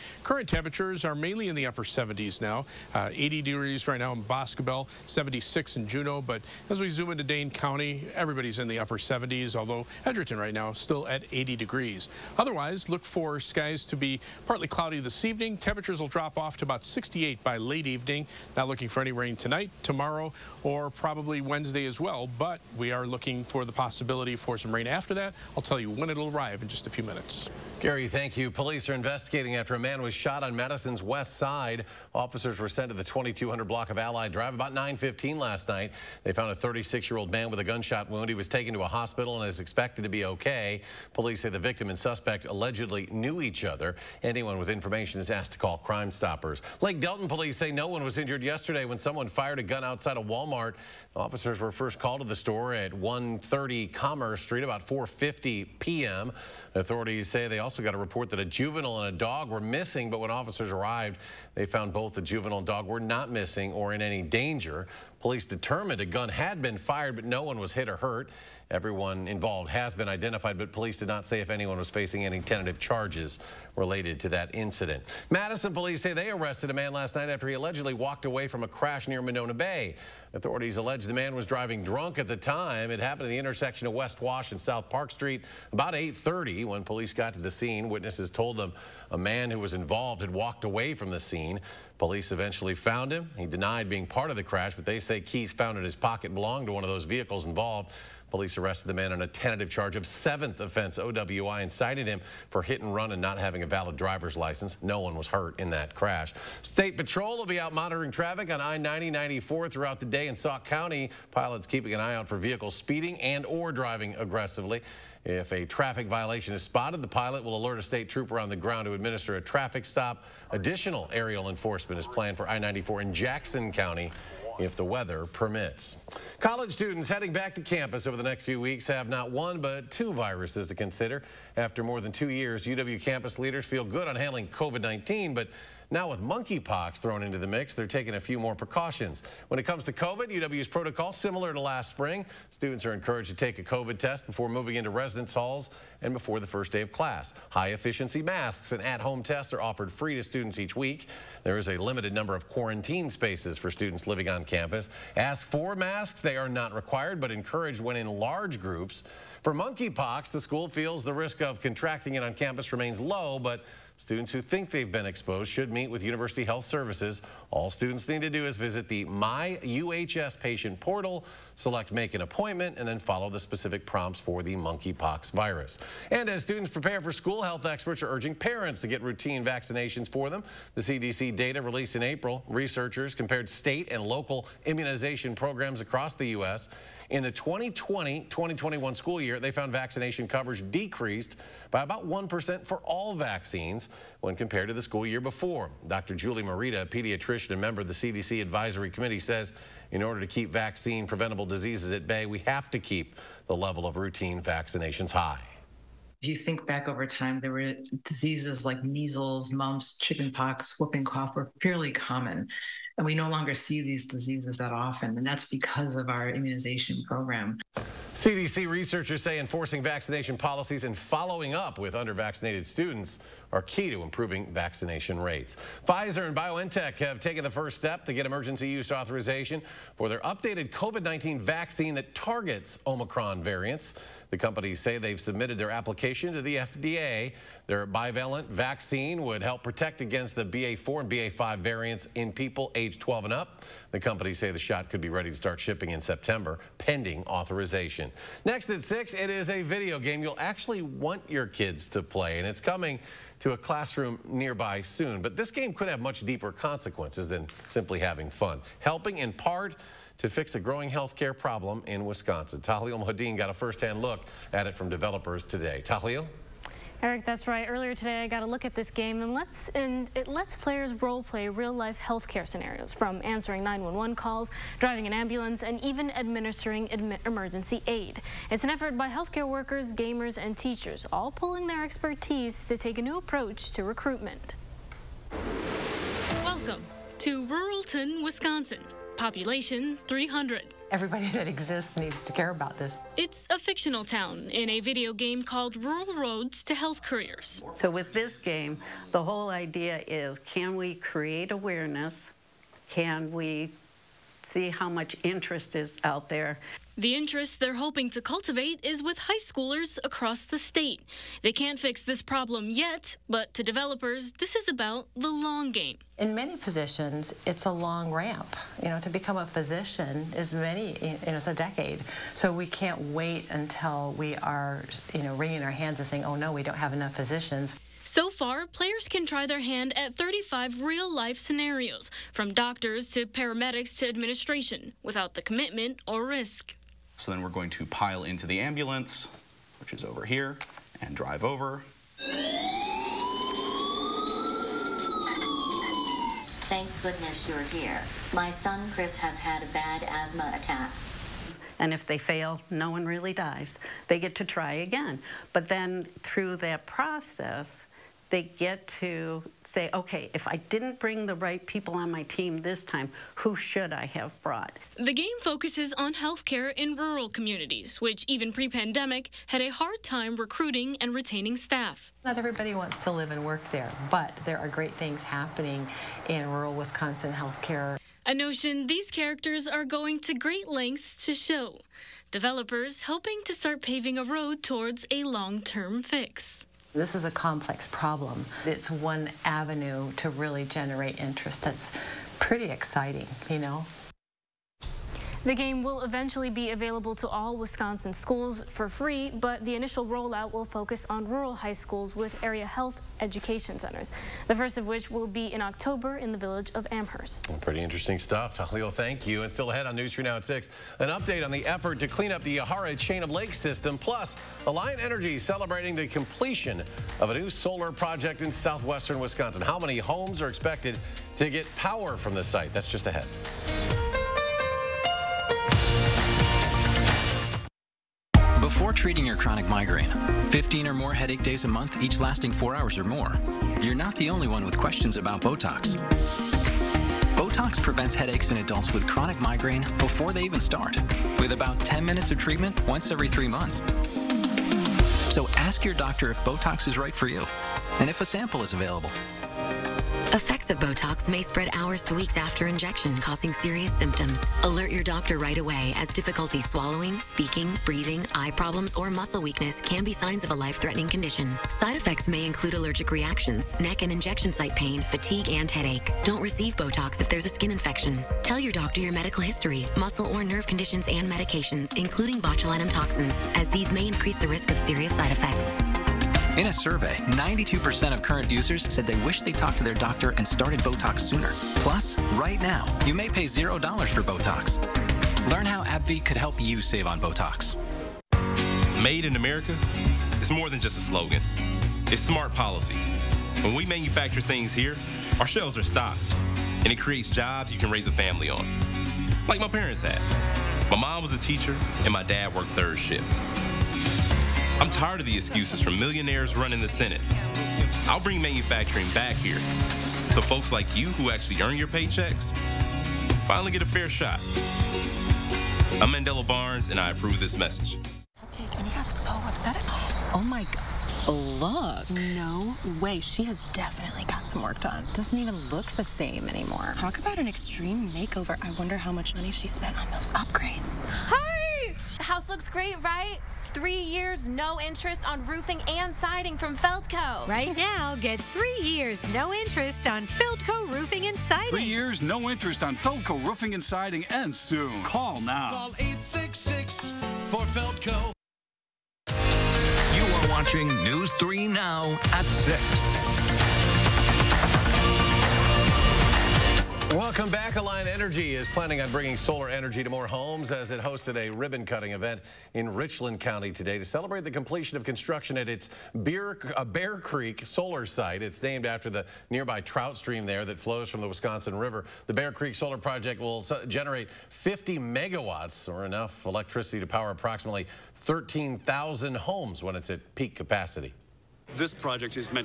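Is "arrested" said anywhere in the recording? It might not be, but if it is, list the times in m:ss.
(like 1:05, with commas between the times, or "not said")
1:16, 1:38.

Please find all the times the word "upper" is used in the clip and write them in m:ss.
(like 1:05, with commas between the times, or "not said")
0:01, 0:08.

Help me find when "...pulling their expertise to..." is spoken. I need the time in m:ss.
4:41.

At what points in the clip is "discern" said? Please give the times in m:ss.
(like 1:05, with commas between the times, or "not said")
not said.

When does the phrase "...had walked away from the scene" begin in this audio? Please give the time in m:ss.
1:30.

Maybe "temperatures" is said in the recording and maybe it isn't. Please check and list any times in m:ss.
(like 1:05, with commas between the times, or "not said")
0:00, 0:15.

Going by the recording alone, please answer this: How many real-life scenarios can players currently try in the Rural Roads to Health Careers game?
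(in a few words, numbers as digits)
35.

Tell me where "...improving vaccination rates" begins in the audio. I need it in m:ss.
3:44.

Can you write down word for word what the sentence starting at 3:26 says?
If you think back over time, there were diseases like measles, mumps, chickenpox, whooping cough were fairly common.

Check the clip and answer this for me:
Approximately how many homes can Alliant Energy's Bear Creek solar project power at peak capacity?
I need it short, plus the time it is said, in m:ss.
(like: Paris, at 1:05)
13,000, at 9:38.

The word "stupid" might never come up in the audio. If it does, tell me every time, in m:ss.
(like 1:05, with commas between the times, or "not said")
not said.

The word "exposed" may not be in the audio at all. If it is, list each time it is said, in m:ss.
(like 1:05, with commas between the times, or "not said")
2:45.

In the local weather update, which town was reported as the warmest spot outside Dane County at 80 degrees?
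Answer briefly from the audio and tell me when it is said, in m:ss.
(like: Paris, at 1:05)
Boscobel, at 0:04.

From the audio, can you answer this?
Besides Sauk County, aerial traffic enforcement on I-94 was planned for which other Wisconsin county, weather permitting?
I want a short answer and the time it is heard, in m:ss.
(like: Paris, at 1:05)
Jackson County, at 2:03.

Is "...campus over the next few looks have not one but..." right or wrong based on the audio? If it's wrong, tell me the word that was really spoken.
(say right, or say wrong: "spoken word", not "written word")
wrong: "weeks", not "looks".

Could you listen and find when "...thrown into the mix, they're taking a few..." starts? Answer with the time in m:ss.
2:16.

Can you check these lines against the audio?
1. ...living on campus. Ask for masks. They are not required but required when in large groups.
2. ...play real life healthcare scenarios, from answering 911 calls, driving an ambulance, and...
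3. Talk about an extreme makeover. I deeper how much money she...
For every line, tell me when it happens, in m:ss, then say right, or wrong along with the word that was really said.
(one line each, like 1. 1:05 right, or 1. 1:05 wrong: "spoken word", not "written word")
1. 2:34 wrong: "encouraged", not "required"
2. 4:31 right
3. 8:46 wrong: "wonder", not "deeper".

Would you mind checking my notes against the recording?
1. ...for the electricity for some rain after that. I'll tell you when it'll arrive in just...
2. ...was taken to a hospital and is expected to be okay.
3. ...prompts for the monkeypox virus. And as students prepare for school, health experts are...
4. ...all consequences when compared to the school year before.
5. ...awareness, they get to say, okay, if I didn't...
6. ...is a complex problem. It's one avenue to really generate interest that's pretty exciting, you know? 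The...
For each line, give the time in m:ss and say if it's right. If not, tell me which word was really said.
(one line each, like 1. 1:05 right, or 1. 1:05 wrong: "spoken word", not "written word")
1. 0:23 wrong: "possibility", not "electricity"
2. 0:38 right
3. 2:53 right
4. 3:12 wrong: "vaccines", not "consequences"
5. 5:56 wrong: "process", not "awareness"
6. 6:27 right.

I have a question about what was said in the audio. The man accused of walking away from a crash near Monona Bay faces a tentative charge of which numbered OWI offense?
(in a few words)
seventh.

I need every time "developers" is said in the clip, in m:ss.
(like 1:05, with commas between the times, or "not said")
4:24, 5:13, 6:22.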